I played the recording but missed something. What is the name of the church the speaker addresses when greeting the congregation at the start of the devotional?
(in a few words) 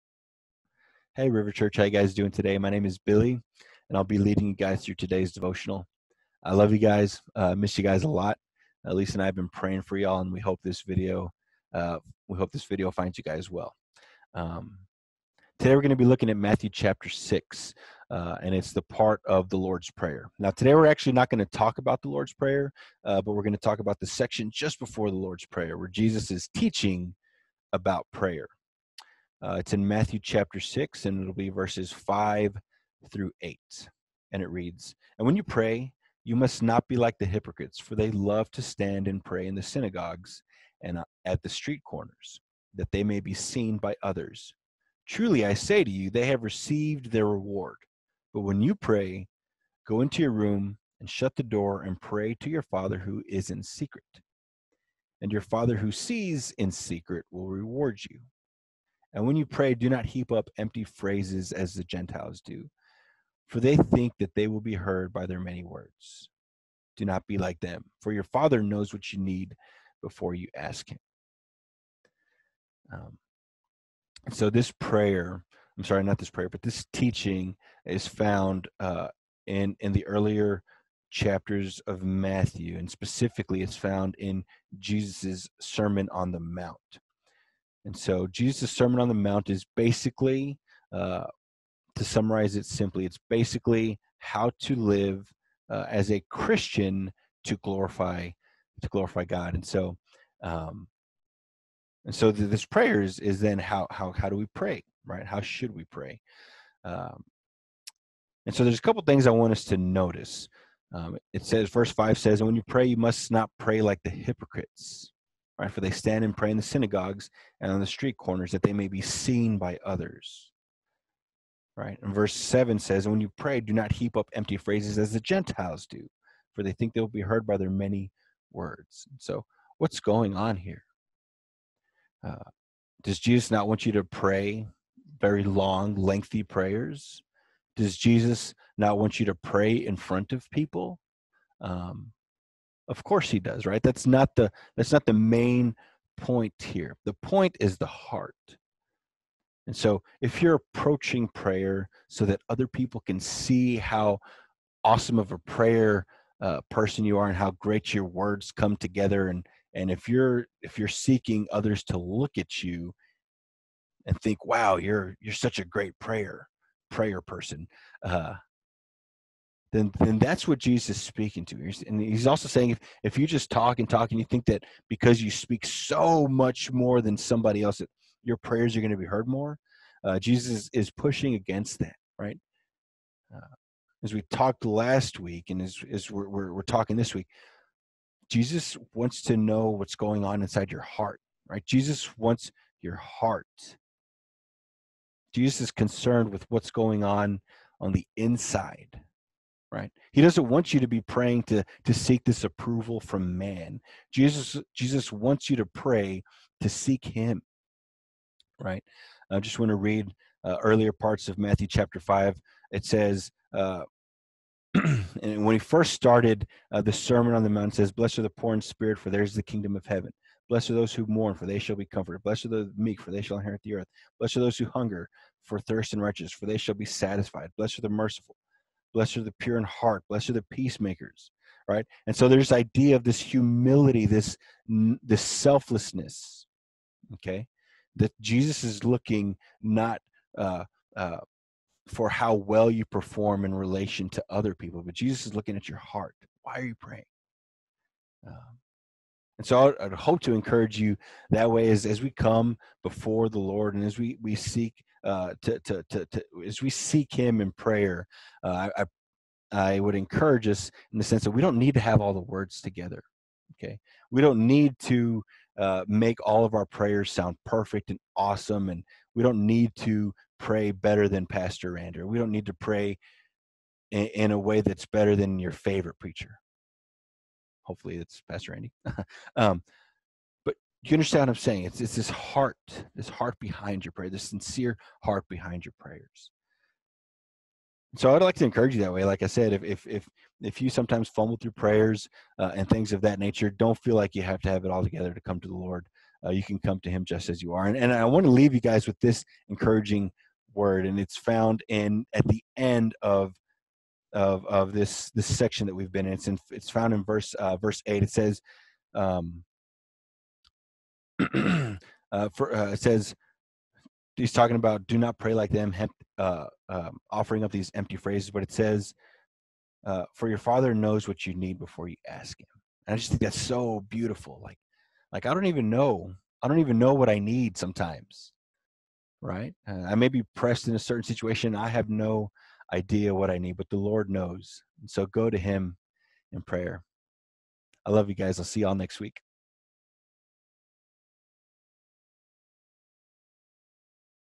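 River Church.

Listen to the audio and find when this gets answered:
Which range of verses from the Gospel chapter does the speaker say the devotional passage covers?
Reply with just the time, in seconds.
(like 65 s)
31 s.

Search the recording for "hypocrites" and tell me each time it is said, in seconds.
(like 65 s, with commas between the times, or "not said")
37 s, 114 s.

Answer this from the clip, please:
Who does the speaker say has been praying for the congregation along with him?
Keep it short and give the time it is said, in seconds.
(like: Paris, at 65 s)
Lisa, at 8 s.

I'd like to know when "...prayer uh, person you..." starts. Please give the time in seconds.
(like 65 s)
155 s.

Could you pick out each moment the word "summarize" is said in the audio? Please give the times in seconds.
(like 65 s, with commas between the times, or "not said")
92 s.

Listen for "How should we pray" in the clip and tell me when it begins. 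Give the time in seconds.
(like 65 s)
105 s.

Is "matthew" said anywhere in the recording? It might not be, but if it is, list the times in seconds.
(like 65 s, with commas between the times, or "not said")
16 s, 29 s, 82 s, 211 s.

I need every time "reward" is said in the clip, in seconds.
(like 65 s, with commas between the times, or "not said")
47 s, 57 s.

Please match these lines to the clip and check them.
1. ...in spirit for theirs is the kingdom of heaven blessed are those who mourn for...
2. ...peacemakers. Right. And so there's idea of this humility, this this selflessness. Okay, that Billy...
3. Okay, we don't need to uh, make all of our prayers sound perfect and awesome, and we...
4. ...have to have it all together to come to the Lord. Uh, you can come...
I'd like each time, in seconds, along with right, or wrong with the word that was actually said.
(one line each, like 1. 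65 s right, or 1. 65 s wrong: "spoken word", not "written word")
1. 218 s right
2. 230 s wrong: "Jesus", not "Billy"
3. 263 s right
4. 294 s right.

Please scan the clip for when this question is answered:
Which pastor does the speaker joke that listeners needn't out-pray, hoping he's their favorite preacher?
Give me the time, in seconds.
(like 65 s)
278 s.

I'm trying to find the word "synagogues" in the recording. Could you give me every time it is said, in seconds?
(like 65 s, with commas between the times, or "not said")
39 s, 116 s.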